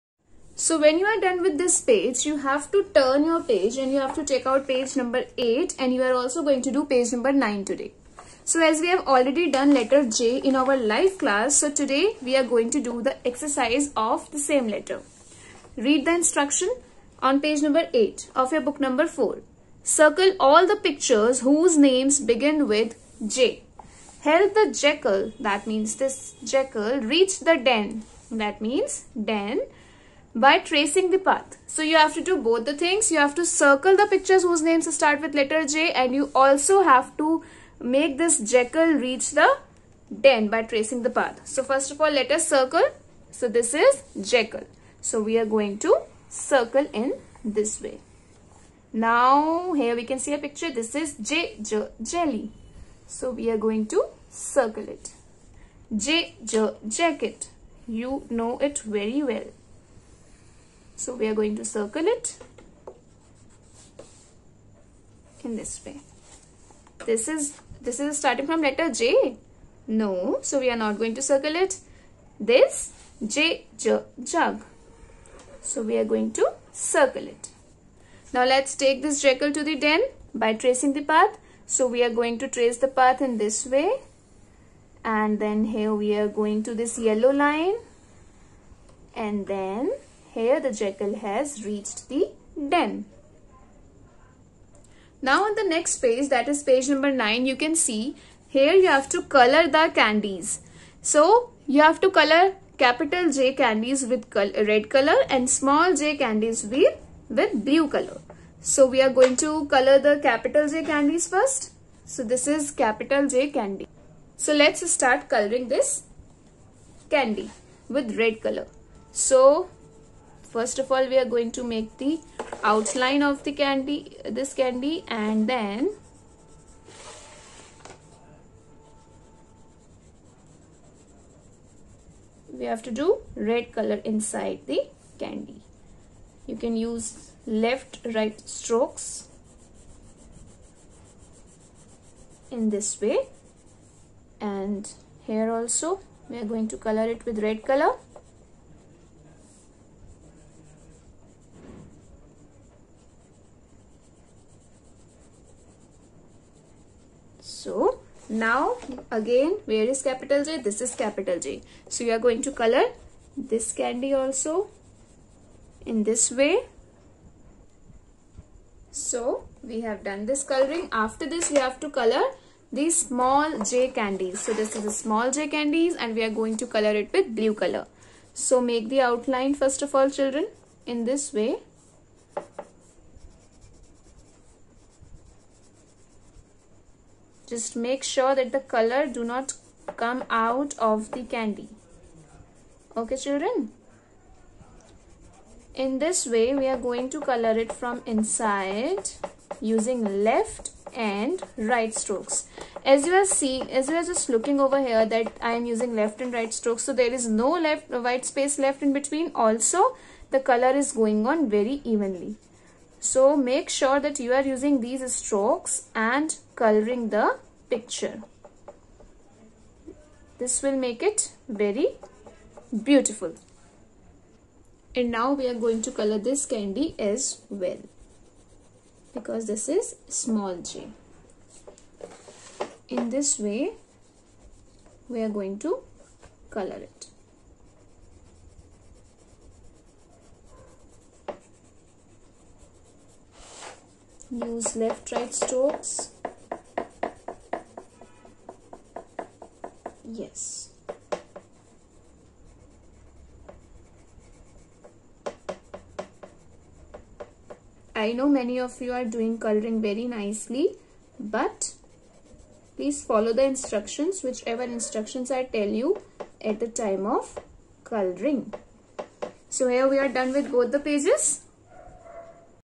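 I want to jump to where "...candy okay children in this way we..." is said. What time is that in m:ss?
3:11.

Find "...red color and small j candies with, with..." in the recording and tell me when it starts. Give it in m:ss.
1:44.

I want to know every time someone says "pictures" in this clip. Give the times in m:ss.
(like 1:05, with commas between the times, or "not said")
0:20, 0:34, 0:50, 3:37.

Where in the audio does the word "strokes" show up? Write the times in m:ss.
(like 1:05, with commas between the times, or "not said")
2:18, 3:22, 3:26, 3:35, 4:05.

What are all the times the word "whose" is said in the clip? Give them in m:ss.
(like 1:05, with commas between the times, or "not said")
0:21, 0:34.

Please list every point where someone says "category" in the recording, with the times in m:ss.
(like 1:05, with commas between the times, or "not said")
not said.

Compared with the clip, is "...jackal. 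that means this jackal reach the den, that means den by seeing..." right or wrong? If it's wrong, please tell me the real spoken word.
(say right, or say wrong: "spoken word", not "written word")
wrong: "tracing", not "seeing".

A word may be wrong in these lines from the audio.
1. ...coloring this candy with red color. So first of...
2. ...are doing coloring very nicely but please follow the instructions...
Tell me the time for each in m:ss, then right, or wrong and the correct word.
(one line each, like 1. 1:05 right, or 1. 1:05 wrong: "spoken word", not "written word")
1. 1:55 right
2. 4:18 right.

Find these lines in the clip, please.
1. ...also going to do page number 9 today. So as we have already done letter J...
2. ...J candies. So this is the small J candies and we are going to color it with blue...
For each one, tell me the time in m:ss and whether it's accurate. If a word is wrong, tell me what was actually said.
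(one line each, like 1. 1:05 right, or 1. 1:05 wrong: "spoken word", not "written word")
1. 0:06 right
2. 2:53 right.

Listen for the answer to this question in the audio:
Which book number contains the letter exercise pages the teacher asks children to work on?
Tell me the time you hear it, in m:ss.
0:18.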